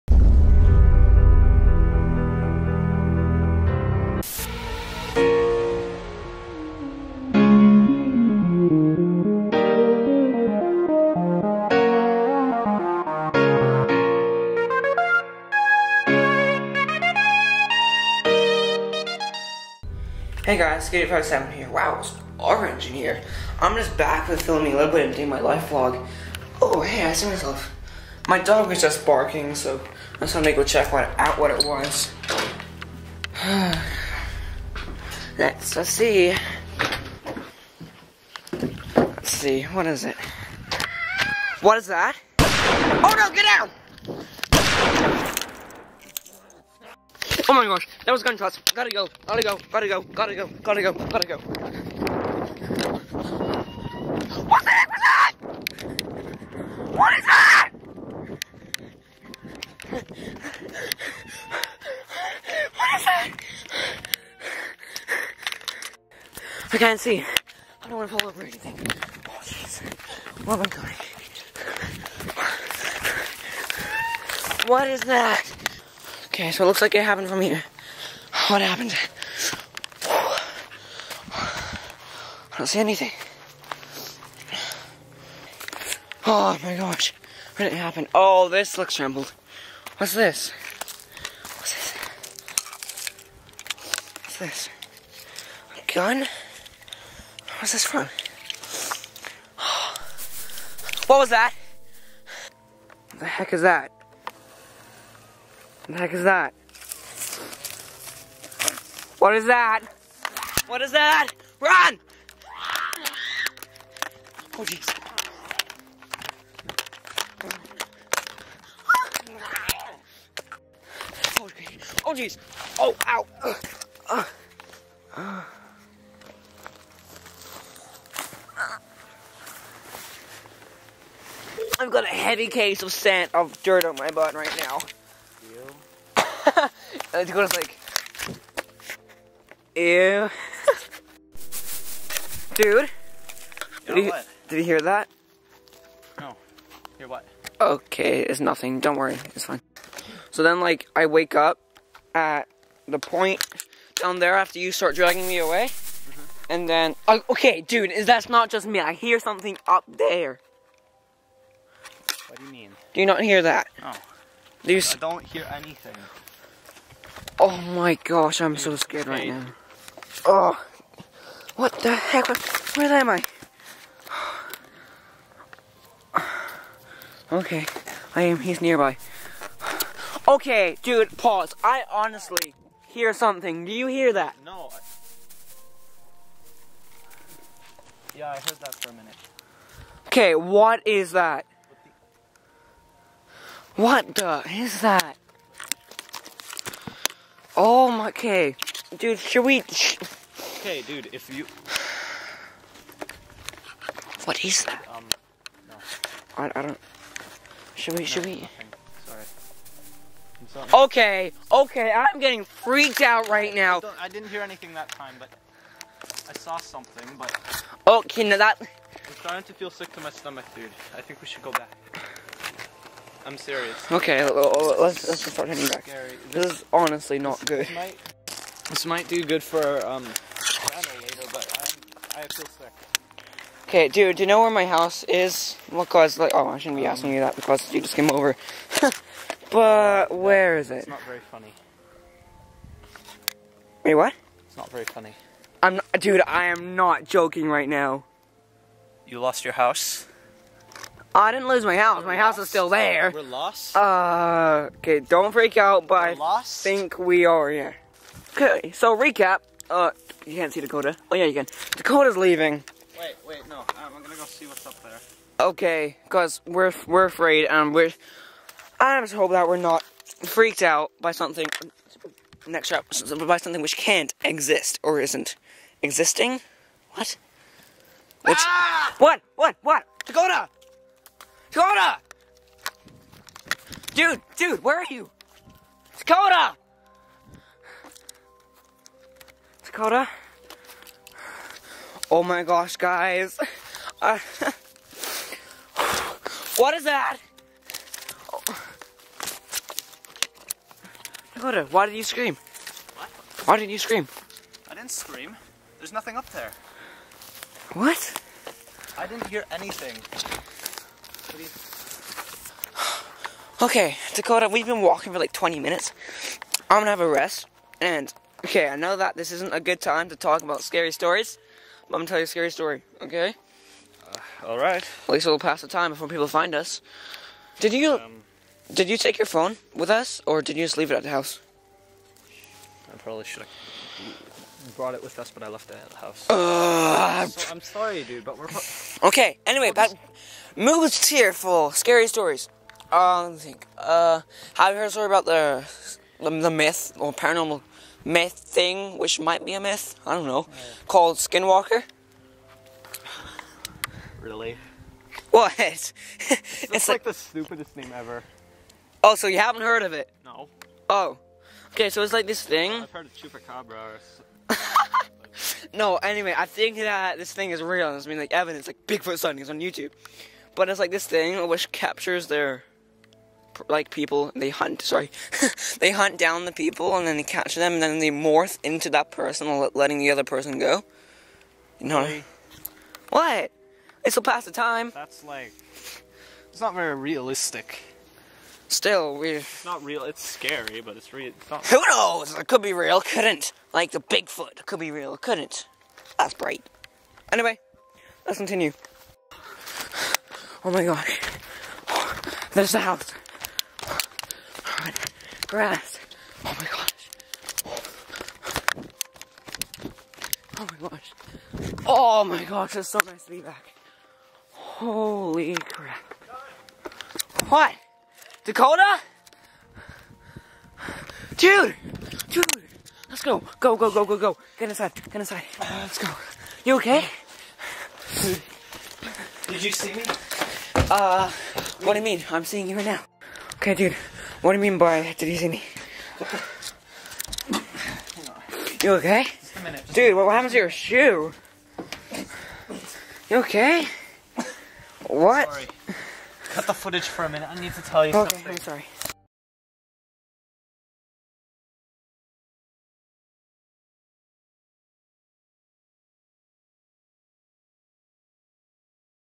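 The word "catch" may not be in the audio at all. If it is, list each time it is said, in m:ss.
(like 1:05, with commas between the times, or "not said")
6:17.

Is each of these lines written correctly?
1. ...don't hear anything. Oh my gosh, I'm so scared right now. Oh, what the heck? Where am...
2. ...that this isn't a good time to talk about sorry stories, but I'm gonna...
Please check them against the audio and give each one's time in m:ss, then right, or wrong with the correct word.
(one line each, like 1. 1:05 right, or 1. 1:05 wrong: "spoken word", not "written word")
1. 2:44 right
2. 5:18 wrong: "scary", not "sorry".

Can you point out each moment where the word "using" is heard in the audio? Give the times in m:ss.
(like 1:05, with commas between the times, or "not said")
not said.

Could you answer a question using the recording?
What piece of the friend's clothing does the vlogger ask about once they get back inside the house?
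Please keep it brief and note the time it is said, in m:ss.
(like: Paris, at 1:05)
shoe, at 7:20.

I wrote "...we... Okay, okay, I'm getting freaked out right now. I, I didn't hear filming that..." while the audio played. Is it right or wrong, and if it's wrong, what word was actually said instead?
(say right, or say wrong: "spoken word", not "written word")
wrong: "anything", not "filming".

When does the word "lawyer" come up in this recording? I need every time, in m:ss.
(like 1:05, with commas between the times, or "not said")
not said.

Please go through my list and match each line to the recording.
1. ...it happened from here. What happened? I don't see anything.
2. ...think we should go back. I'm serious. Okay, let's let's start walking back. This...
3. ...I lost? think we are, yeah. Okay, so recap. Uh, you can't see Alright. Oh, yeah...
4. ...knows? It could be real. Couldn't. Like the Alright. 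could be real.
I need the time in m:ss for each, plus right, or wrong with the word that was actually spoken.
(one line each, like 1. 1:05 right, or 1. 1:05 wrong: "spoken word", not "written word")
1. 1:16 right
2. 3:41 wrong: "heading", not "walking"
3. 4:16 wrong: "Dakota", not "Alright"
4. 6:31 wrong: "Bigfoot", not "Alright".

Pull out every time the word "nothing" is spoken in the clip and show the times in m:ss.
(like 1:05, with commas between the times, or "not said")
2:28, 5:05.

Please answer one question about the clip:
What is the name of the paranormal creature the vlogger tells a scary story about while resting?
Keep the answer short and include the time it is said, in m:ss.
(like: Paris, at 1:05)
Skinwalker, at 5:51.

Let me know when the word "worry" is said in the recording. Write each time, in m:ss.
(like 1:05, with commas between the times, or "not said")
2:28.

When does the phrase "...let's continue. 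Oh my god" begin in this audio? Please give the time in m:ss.
6:38.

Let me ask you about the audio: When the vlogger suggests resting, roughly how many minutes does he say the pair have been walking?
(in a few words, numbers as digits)
20 minutes.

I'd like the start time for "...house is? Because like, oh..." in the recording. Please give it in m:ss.
3:54.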